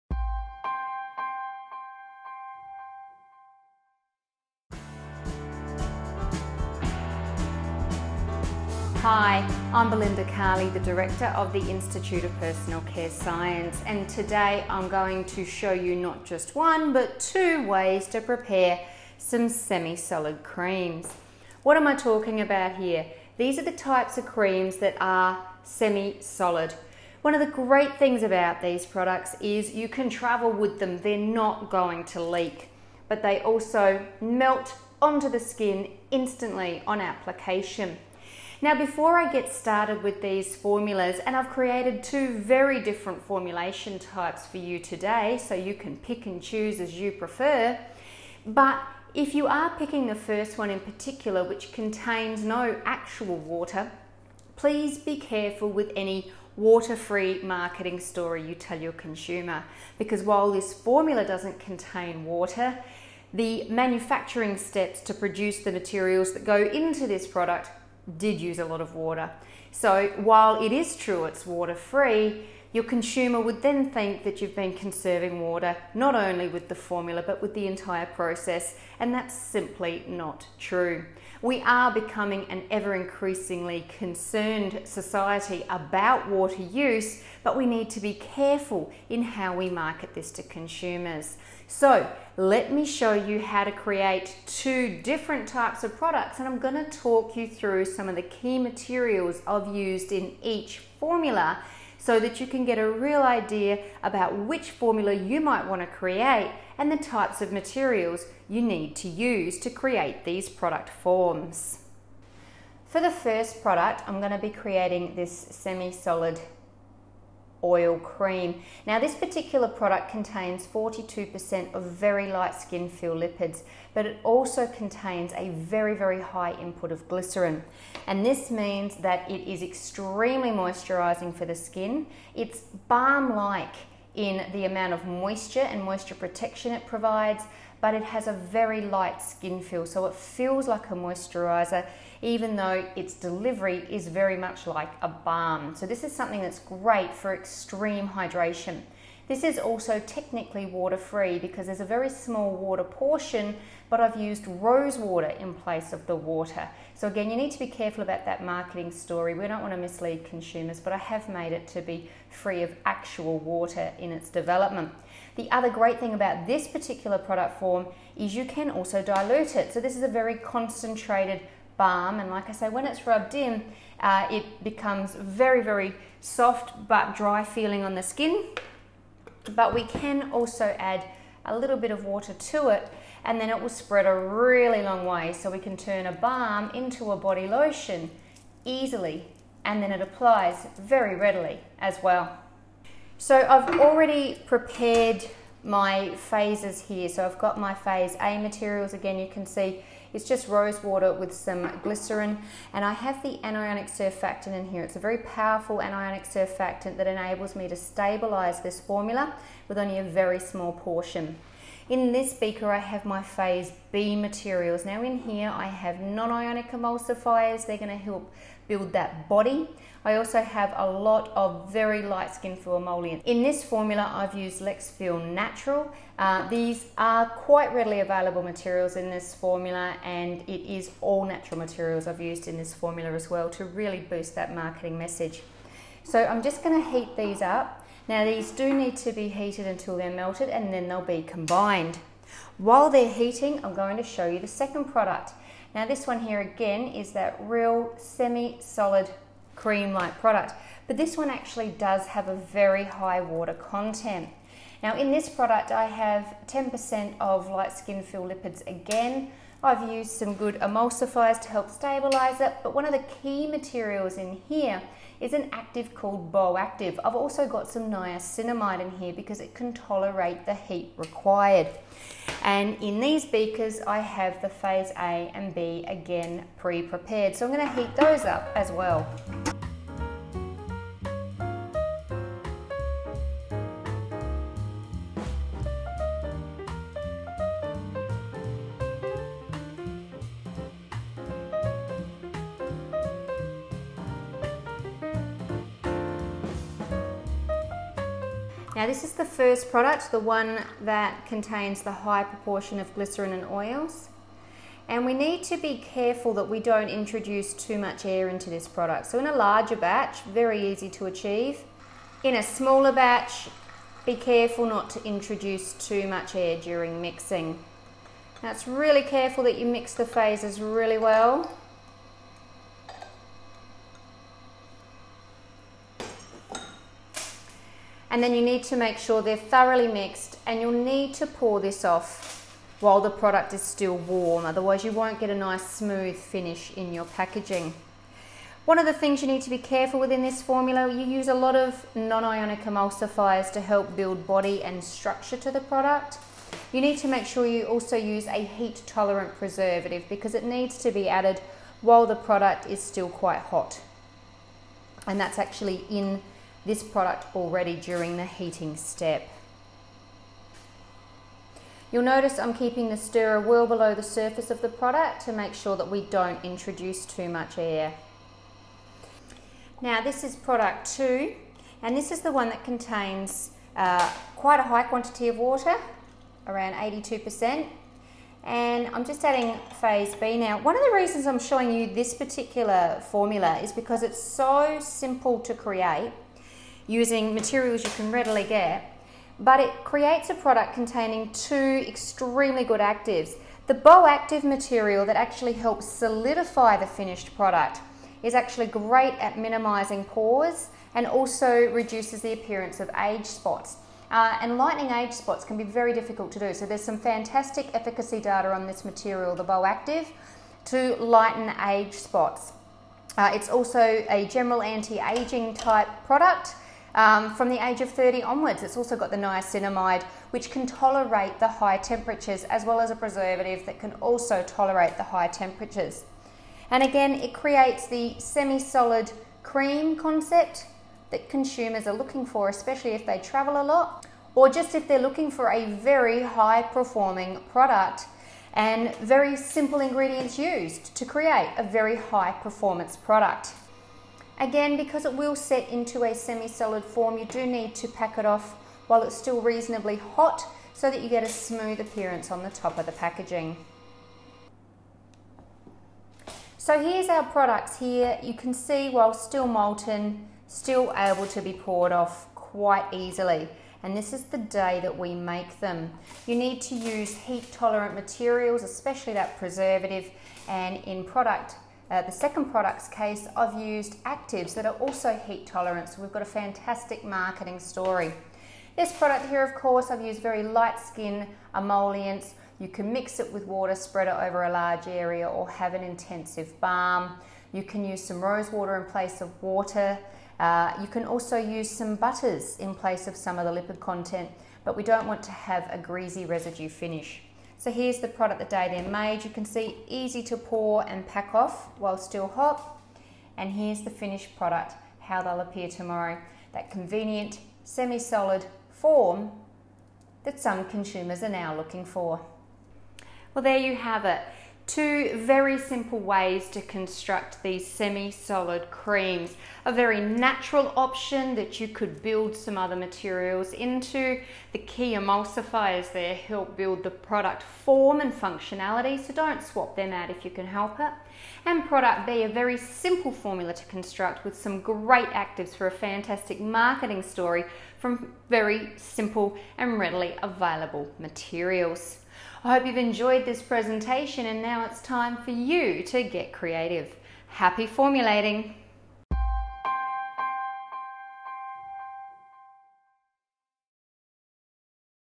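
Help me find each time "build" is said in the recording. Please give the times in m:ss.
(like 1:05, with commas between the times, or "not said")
3:38, 5:43, 8:42, 8:46.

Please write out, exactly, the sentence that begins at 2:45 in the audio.
The other great thing about this particular product form is you can also dilute it.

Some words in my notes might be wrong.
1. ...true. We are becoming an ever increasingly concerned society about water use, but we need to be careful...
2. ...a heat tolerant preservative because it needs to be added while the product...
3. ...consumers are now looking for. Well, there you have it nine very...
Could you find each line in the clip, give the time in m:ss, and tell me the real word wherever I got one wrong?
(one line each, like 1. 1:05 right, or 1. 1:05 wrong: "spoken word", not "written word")
1. 1:20 right
2. 5:48 right
3. 8:30 wrong: "two", not "nine".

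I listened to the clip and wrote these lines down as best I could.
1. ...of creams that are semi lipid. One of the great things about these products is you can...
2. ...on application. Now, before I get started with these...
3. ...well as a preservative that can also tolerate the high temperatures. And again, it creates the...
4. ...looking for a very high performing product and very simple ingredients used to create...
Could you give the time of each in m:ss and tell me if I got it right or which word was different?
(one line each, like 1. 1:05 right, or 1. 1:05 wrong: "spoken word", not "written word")
1. 0:24 wrong: "solid", not "lipid"
2. 0:36 right
3. 7:02 right
4. 7:14 right.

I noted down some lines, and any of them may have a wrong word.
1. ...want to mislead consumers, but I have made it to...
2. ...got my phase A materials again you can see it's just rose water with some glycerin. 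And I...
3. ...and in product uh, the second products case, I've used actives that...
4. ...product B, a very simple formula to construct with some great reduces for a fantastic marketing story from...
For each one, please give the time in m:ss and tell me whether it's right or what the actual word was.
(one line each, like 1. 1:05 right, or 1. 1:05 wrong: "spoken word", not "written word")
1. 2:39 right
2. 3:17 right
3. 7:50 right
4. 8:51 wrong: "actives", not "reduces".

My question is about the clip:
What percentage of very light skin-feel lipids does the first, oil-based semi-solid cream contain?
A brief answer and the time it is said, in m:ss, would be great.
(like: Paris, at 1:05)
42%, at 2:00.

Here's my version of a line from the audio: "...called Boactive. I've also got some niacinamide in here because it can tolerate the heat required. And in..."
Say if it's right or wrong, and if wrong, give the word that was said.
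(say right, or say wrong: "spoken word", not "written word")
right.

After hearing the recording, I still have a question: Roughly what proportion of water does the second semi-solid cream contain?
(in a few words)
82%.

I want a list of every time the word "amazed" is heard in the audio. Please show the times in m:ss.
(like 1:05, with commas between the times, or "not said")
not said.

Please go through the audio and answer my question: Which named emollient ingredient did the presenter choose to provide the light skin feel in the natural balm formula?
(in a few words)
LexFeel Natural.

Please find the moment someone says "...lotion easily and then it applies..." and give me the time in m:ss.
3:07.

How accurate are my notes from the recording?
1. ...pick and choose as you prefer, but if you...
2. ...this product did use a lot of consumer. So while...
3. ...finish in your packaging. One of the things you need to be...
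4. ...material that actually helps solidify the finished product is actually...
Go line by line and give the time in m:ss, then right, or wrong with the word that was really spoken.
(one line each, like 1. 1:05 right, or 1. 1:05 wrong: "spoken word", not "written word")
1. 0:45 right
2. 1:07 wrong: "water", not "consumer"
3. 5:36 right
4. 6:34 right.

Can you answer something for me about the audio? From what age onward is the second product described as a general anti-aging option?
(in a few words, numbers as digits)
30.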